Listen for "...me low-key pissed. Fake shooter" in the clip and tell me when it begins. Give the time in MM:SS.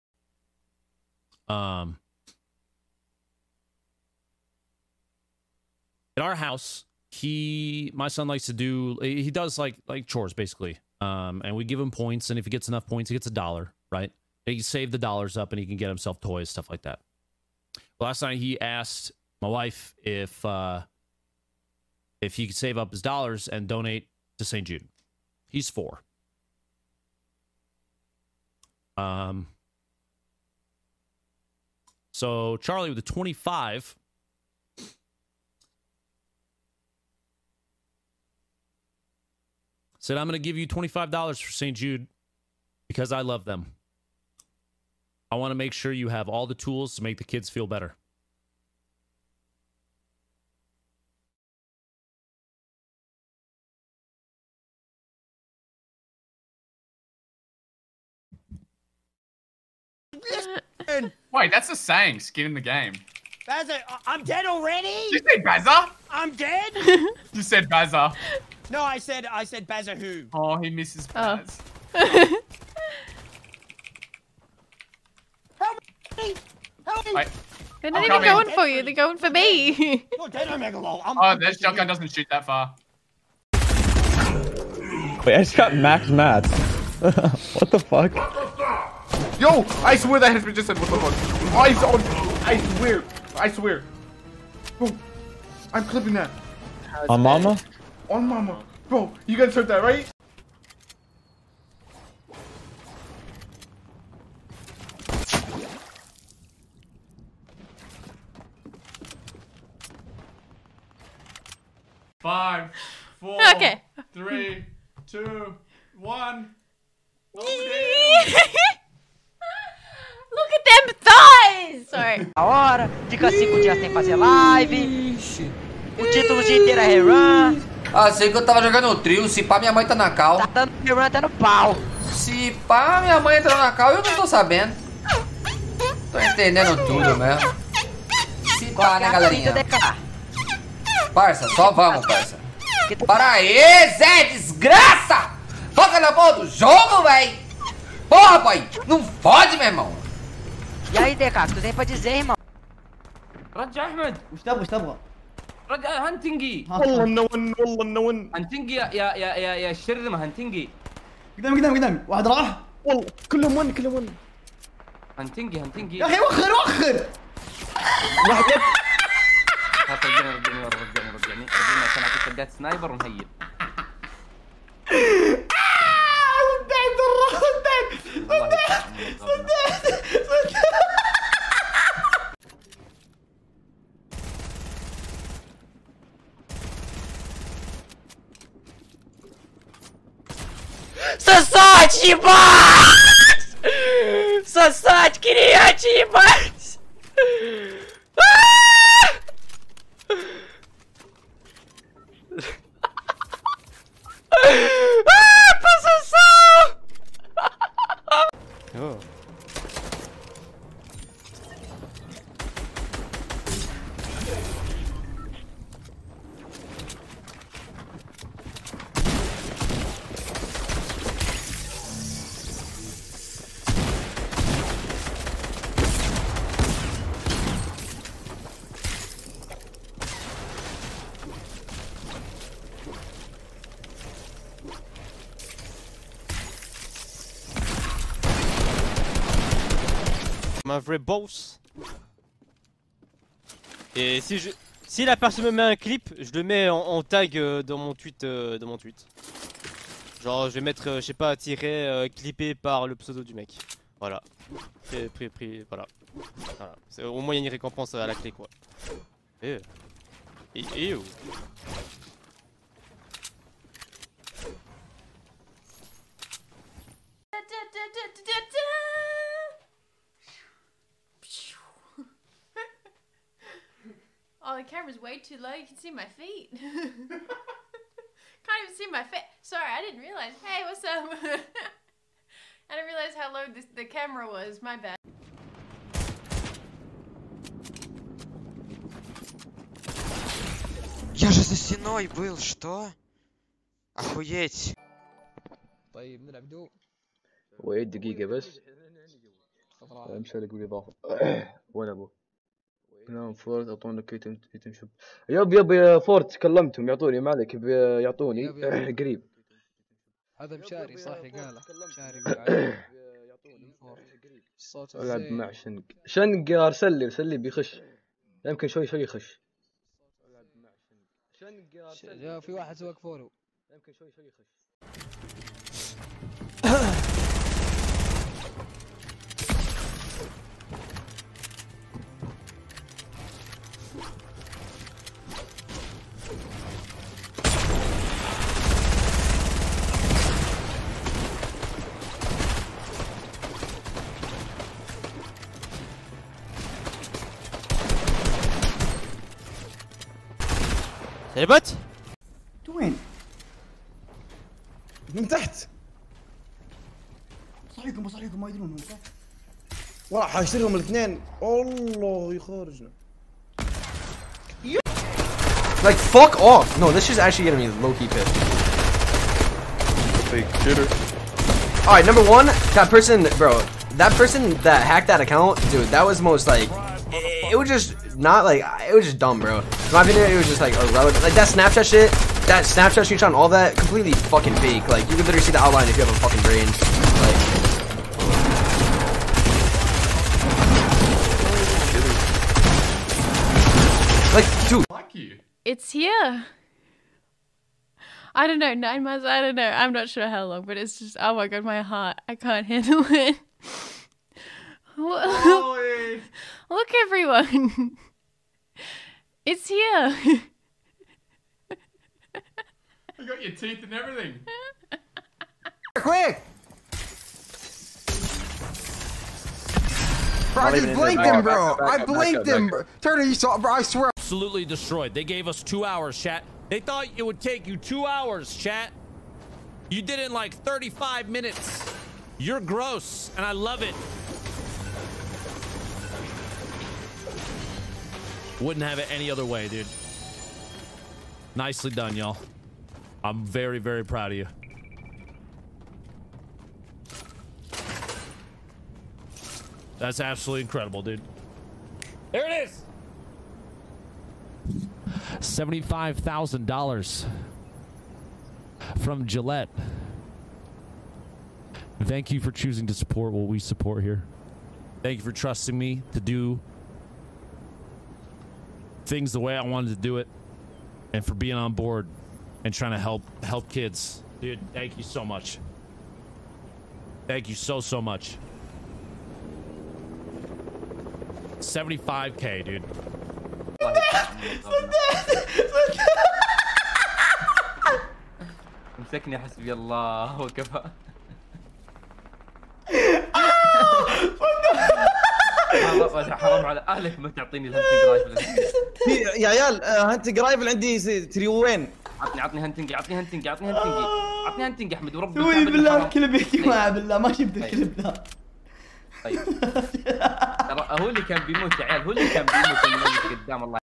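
06:07.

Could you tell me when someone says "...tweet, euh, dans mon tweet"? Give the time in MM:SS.
04:07.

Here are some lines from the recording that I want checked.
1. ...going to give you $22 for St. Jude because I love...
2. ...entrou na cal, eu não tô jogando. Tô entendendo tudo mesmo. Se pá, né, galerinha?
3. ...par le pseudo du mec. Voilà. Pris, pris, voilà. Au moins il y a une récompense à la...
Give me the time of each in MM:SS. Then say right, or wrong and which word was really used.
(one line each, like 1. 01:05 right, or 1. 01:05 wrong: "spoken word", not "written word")
1. 00:40 wrong: "25", not "22"
2. 02:13 wrong: "sabendo", not "jogando"
3. 04:12 right.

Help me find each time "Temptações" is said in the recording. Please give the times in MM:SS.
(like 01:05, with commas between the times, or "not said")
02:00.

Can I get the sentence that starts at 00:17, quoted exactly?
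Last night he asked my wife if uh, if he could save up his dollars and donate to St.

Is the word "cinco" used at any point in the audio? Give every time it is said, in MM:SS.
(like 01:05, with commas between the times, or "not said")
02:03.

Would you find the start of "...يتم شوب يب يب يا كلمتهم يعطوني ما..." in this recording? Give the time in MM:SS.
05:04.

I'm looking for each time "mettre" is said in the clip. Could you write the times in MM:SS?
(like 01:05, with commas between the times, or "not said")
04:10.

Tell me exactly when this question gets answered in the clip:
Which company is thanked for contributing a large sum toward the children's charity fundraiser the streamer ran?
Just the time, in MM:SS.
07:39.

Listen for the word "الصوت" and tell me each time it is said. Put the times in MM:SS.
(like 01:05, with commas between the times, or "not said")
05:14.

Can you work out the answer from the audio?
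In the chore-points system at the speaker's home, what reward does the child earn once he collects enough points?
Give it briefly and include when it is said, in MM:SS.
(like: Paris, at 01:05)
a dollar, at 00:13.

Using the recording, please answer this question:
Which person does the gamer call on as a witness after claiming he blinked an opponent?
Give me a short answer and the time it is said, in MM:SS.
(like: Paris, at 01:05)
Turner, at 07:03.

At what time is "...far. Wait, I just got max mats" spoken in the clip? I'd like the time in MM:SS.
01:22.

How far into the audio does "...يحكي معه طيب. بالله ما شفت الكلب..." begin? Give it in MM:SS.
08:26.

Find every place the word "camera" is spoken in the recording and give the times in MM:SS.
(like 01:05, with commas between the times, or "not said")
04:34, 04:43.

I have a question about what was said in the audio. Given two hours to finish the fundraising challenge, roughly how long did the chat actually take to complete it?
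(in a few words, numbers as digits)
35 minutes.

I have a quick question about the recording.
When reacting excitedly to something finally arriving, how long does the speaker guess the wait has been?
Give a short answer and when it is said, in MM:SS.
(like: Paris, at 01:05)
9 months, at 06:38.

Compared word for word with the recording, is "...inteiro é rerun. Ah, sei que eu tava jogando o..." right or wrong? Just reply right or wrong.
right.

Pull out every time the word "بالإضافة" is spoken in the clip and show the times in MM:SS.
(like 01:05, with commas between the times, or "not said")
05:00.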